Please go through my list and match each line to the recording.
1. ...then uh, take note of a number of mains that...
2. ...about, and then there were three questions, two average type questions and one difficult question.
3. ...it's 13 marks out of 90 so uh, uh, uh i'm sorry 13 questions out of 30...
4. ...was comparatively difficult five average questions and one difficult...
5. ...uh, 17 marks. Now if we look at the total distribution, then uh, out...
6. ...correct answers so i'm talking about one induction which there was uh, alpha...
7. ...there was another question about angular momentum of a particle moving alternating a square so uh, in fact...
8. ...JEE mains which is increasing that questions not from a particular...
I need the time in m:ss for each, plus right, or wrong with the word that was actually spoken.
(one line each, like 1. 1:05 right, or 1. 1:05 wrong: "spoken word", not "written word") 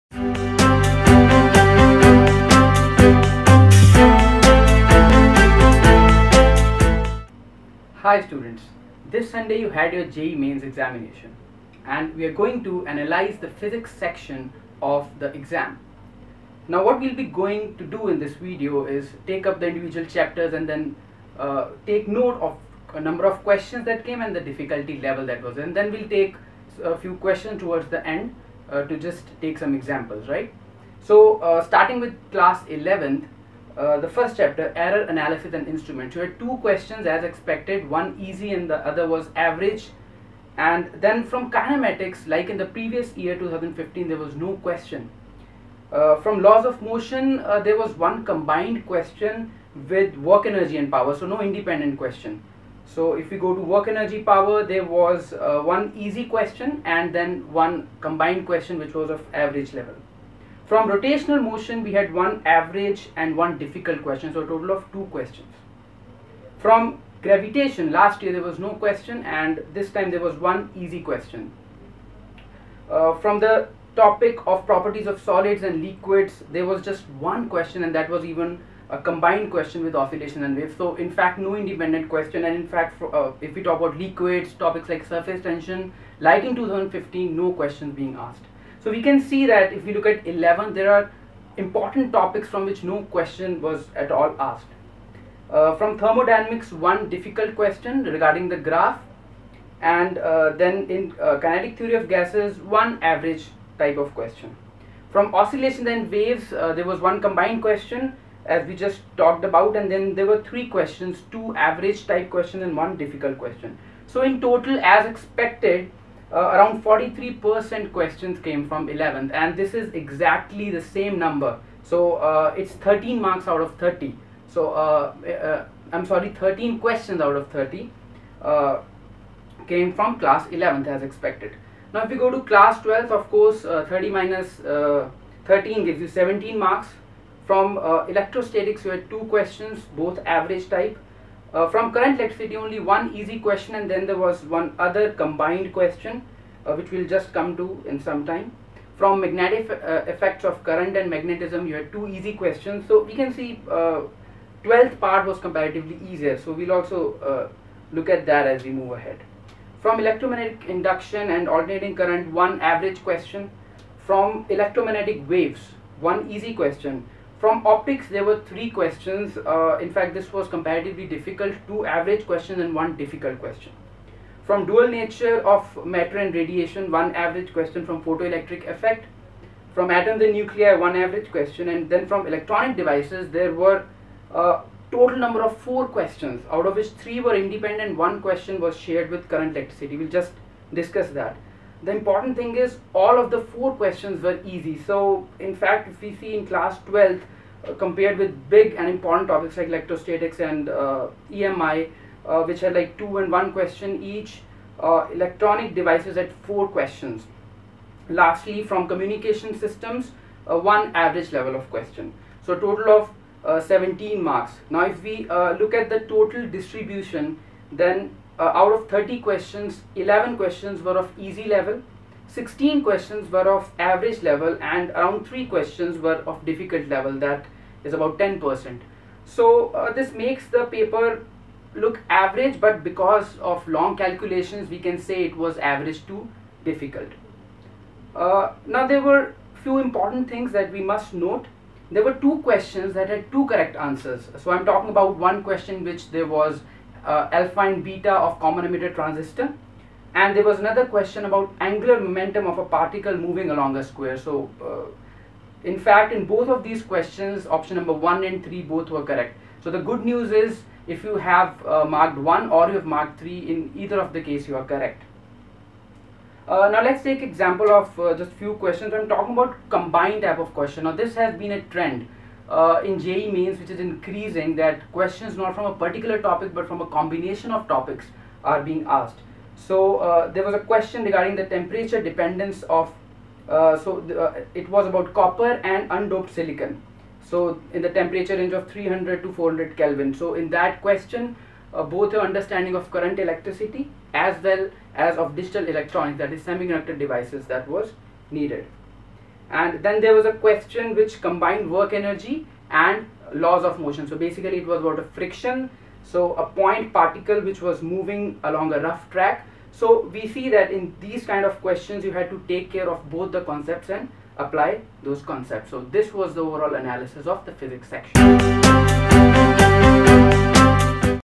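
1. 0:20 wrong: "questions", not "mains"
2. 1:49 right
3. 2:02 wrong: "30", not "90"
4. 2:50 wrong: "two", not "five"
5. 3:33 right
6. 4:03 wrong: "question", not "induction"
7. 4:10 wrong: "along", not "alternating"
8. 4:32 right.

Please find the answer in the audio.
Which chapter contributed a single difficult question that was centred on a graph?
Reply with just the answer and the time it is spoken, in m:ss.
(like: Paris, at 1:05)
thermodynamics, at 1:35.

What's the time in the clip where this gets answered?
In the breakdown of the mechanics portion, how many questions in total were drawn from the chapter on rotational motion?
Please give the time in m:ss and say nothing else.
1:04.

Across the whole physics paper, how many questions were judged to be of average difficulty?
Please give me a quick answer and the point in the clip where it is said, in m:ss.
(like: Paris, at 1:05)
16, at 3:42.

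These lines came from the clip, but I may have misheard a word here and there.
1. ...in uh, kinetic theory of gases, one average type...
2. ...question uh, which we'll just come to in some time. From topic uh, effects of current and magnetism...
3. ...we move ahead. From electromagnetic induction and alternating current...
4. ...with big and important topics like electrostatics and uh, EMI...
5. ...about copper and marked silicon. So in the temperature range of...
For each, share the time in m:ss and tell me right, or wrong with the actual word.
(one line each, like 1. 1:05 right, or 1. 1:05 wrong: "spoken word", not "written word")
1. 1:40 right
2. 2:25 wrong: "magnetic", not "topic"
3. 2:38 right
4. 3:18 right
5. 4:44 wrong: "undoped", not "marked".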